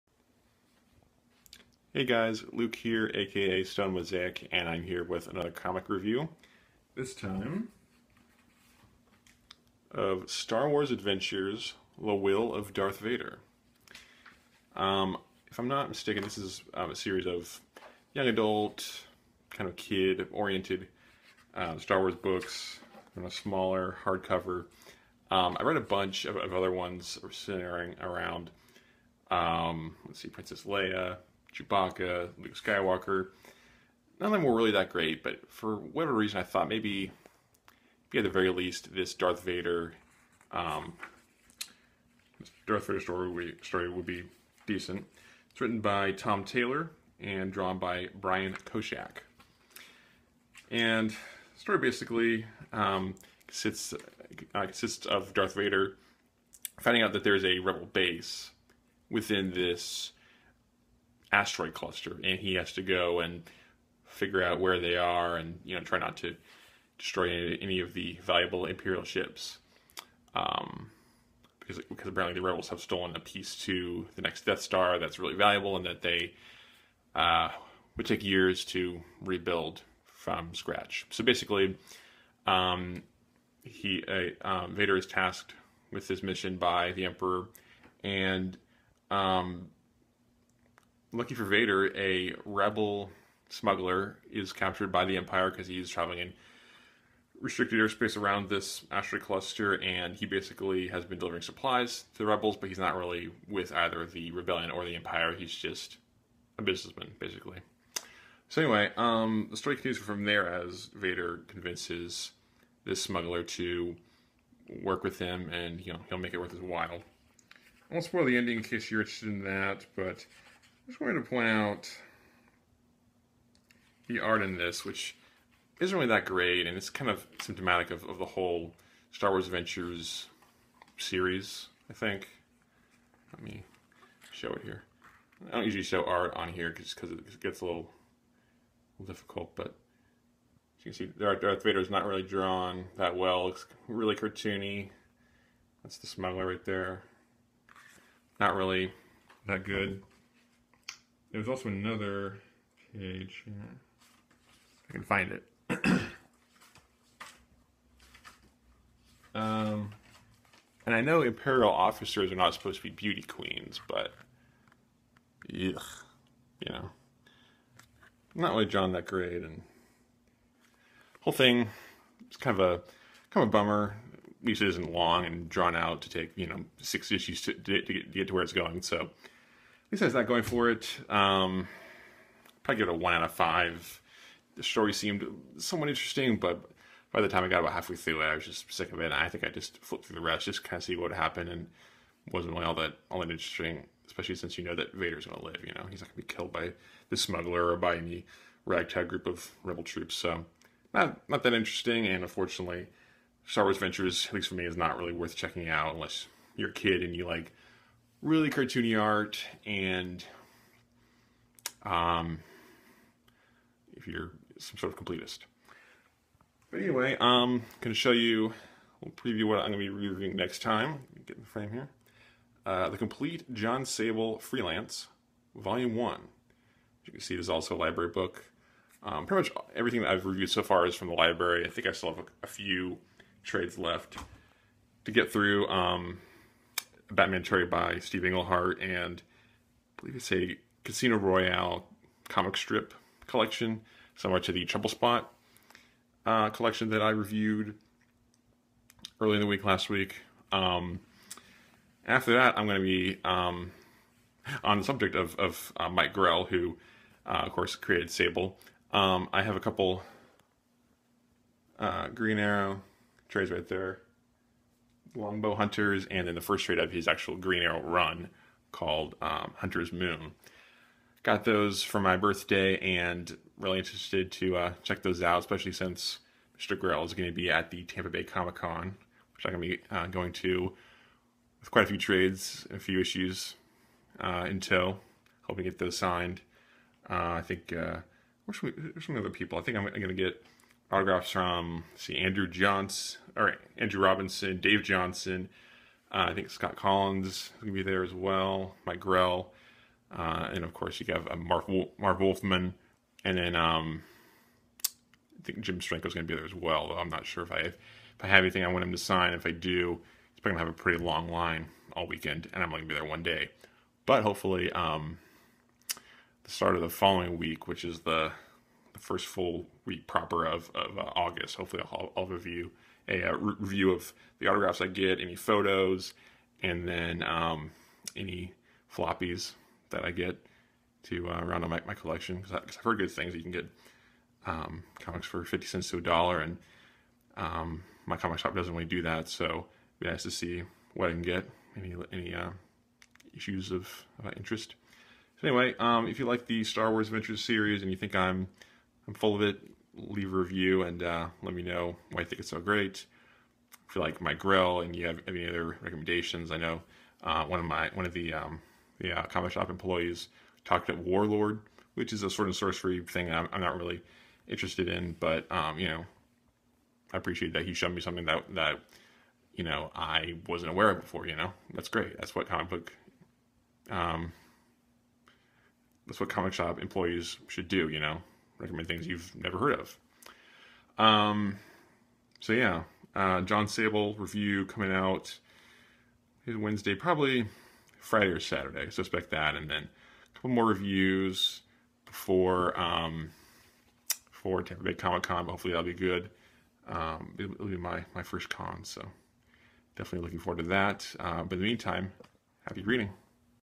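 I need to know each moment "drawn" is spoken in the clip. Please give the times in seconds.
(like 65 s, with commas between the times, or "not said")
47 s, 142 s, 175 s.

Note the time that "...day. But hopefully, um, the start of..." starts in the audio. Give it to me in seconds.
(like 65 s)
313 s.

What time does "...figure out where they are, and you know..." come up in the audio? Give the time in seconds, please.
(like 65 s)
64 s.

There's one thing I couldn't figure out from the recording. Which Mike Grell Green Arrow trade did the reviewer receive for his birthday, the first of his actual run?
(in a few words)
Hunter's Moon.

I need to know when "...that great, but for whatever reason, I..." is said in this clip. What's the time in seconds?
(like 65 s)
34 s.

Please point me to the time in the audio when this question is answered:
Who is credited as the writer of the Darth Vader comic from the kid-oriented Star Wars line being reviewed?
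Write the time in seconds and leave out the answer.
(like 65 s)
46 s.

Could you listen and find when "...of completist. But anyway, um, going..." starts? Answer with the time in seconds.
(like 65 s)
214 s.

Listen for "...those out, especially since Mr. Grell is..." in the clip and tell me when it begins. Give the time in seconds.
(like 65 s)
275 s.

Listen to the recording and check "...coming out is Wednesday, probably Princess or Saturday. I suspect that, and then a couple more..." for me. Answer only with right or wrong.
wrong.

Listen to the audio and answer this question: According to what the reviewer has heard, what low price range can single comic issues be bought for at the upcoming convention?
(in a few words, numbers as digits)
50 cents to a dollar.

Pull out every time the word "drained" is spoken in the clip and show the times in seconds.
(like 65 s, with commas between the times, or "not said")
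not said.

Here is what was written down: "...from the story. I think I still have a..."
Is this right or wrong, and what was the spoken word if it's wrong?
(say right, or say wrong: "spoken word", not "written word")
wrong: "library", not "story".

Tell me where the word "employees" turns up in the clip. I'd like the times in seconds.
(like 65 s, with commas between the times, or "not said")
359 s, 376 s.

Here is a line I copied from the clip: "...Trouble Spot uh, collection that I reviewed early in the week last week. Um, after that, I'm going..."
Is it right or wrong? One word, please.
right.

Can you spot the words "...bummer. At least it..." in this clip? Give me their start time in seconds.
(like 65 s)
173 s.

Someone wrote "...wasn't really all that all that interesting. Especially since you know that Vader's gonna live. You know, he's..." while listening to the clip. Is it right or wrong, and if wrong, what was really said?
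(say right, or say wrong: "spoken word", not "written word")
right.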